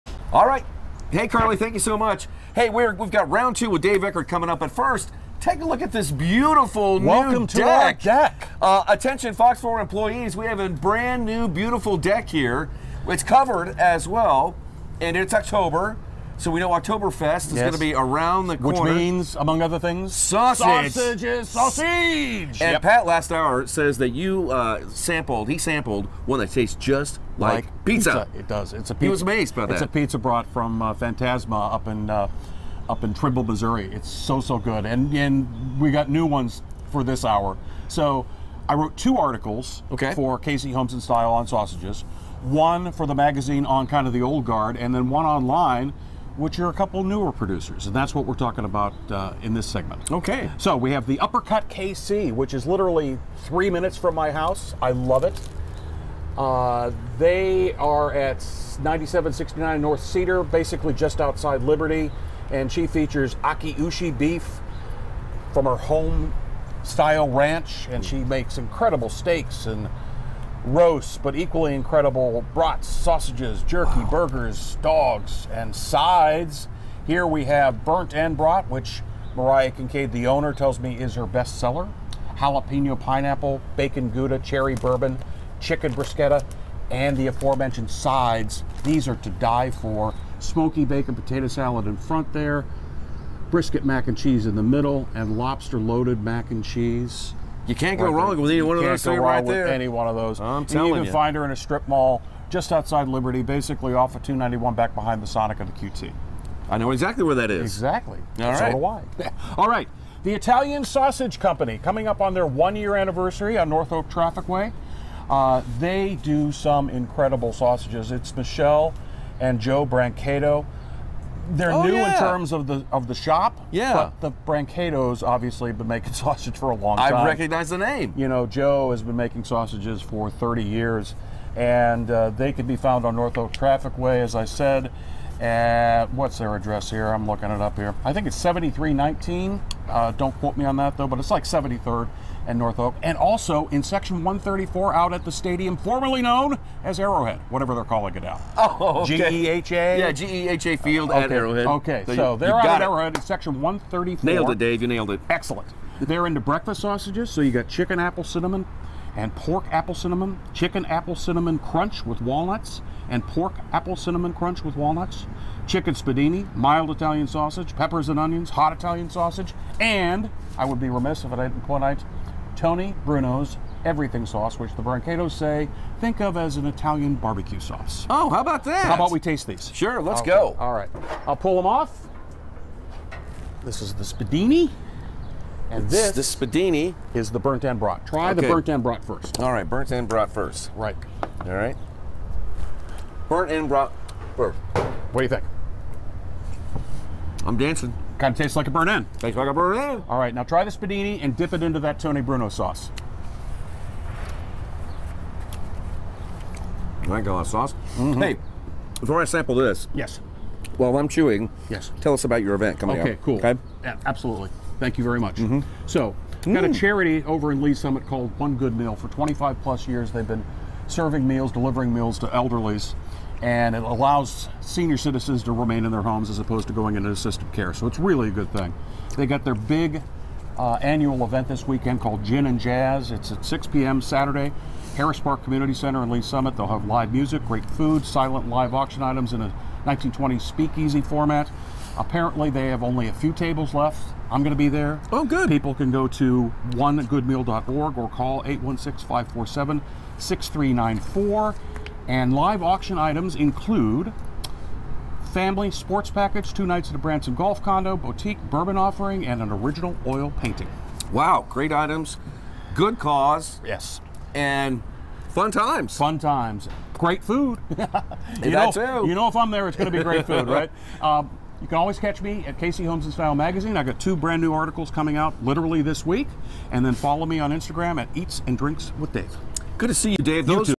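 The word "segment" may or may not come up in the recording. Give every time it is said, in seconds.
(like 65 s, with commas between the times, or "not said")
49 s.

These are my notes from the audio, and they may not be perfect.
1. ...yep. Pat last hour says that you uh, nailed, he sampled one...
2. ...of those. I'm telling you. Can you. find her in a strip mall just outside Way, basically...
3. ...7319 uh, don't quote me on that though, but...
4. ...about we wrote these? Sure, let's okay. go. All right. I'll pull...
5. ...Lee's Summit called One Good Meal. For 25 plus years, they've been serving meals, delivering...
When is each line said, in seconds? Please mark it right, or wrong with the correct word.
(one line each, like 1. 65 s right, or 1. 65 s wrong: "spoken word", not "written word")
1. 22 s wrong: "sampled", not "nailed"
2. 100 s wrong: "Liberty", not "Way"
3. 138 s right
4. 178 s wrong: "taste", not "wrote"
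5. 217 s right.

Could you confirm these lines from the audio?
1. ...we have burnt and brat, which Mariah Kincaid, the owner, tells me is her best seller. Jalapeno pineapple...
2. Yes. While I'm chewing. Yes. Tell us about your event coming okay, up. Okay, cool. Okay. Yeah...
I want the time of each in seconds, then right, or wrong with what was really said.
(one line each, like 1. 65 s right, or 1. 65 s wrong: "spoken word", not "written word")
1. 77 s right
2. 209 s right.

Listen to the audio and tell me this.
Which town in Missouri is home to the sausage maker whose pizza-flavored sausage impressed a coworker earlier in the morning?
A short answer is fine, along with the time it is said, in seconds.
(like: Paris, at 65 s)
Trimble, at 33 s.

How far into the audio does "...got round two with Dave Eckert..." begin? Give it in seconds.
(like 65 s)
3 s.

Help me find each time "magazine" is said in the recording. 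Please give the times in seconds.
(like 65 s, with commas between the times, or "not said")
43 s, 273 s.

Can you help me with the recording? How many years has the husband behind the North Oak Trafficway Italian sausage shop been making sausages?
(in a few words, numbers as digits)
30.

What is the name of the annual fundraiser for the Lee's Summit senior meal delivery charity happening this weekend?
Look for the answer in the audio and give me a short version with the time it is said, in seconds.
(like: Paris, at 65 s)
Gin and Jazz, at 232 s.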